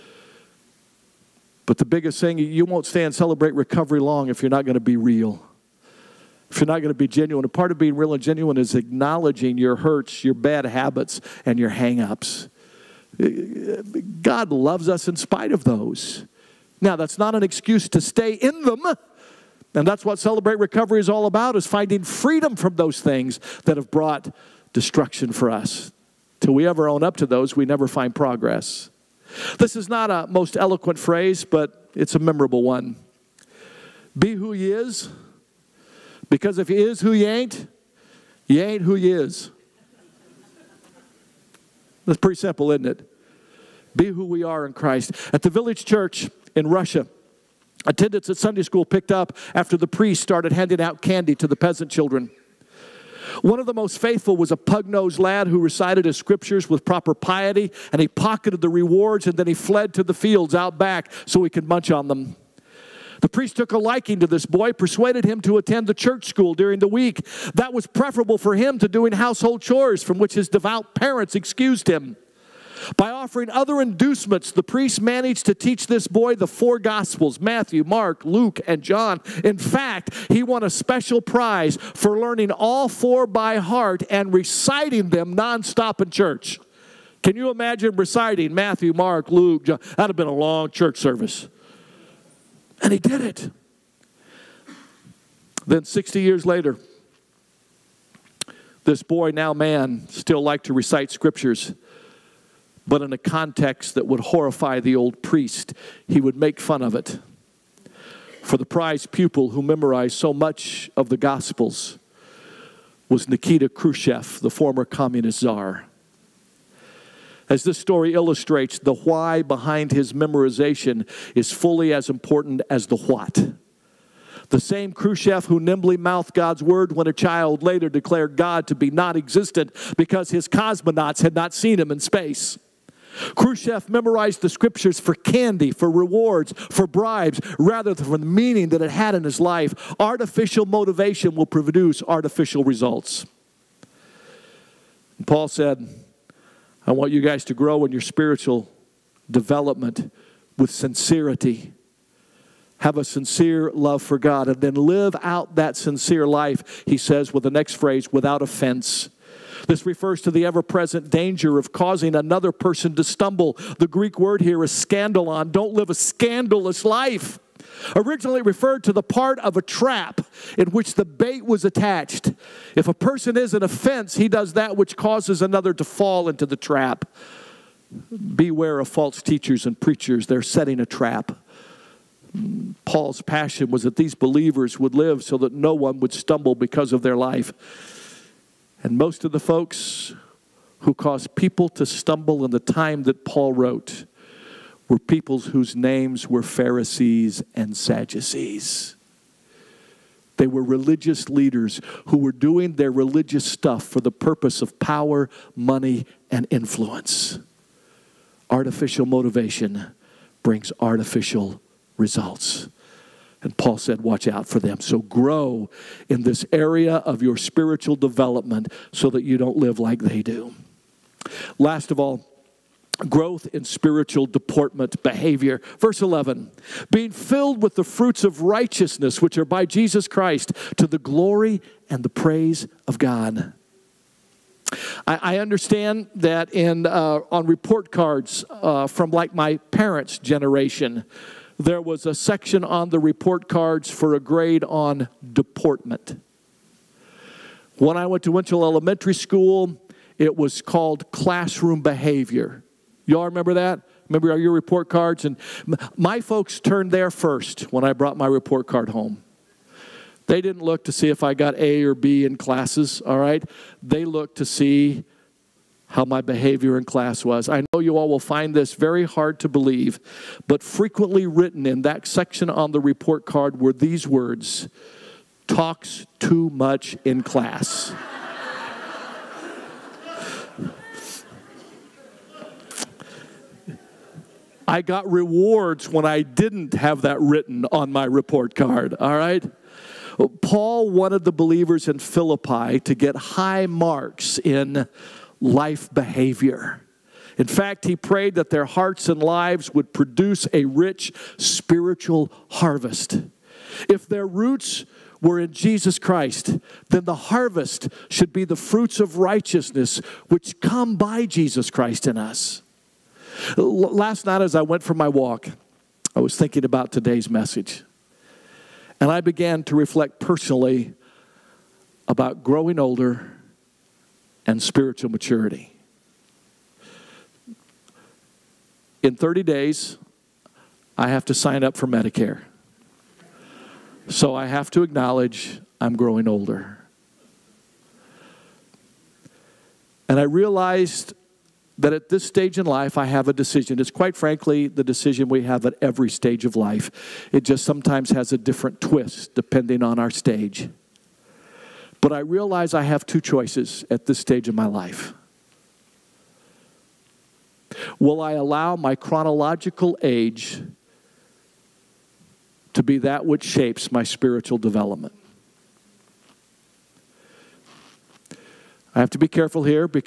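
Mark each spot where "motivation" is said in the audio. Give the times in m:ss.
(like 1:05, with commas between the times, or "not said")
2:20, 3:29.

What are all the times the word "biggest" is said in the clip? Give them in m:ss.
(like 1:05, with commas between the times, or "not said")
0:01.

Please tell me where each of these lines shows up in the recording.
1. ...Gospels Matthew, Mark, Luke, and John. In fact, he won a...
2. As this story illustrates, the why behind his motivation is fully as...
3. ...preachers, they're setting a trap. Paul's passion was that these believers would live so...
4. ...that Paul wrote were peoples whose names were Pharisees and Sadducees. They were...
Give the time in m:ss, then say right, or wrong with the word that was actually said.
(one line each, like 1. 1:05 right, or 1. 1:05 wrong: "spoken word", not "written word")
1. 1:16 right
2. 1:57 wrong: "memorization", not "motivation"
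3. 2:59 right
4. 3:13 right.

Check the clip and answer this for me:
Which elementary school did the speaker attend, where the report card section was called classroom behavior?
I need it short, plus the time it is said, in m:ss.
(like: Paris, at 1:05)
Winchell Elementary School, at 4:08.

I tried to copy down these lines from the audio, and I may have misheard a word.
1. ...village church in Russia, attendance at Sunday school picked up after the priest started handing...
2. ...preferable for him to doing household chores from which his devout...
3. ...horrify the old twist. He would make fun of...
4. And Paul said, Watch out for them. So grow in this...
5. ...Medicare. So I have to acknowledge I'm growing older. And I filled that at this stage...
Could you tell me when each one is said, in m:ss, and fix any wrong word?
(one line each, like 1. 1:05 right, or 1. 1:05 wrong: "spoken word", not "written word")
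1. 0:45 right
2. 1:07 right
3. 1:44 wrong: "priest", not "twist"
4. 3:33 right
5. 5:31 wrong: "realized", not "filled".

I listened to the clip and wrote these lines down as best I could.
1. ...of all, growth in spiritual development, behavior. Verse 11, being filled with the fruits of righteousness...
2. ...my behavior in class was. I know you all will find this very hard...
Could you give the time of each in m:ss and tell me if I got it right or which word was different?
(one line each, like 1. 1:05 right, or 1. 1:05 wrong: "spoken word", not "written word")
1. 3:41 wrong: "deportment", not "development"
2. 4:26 right.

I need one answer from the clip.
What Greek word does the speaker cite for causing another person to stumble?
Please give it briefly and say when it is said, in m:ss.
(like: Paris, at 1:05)
scandalon, at 2:44.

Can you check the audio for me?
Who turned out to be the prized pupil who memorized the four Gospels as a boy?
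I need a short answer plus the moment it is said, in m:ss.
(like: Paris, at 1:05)
Nikita Khrushchev, at 1:53.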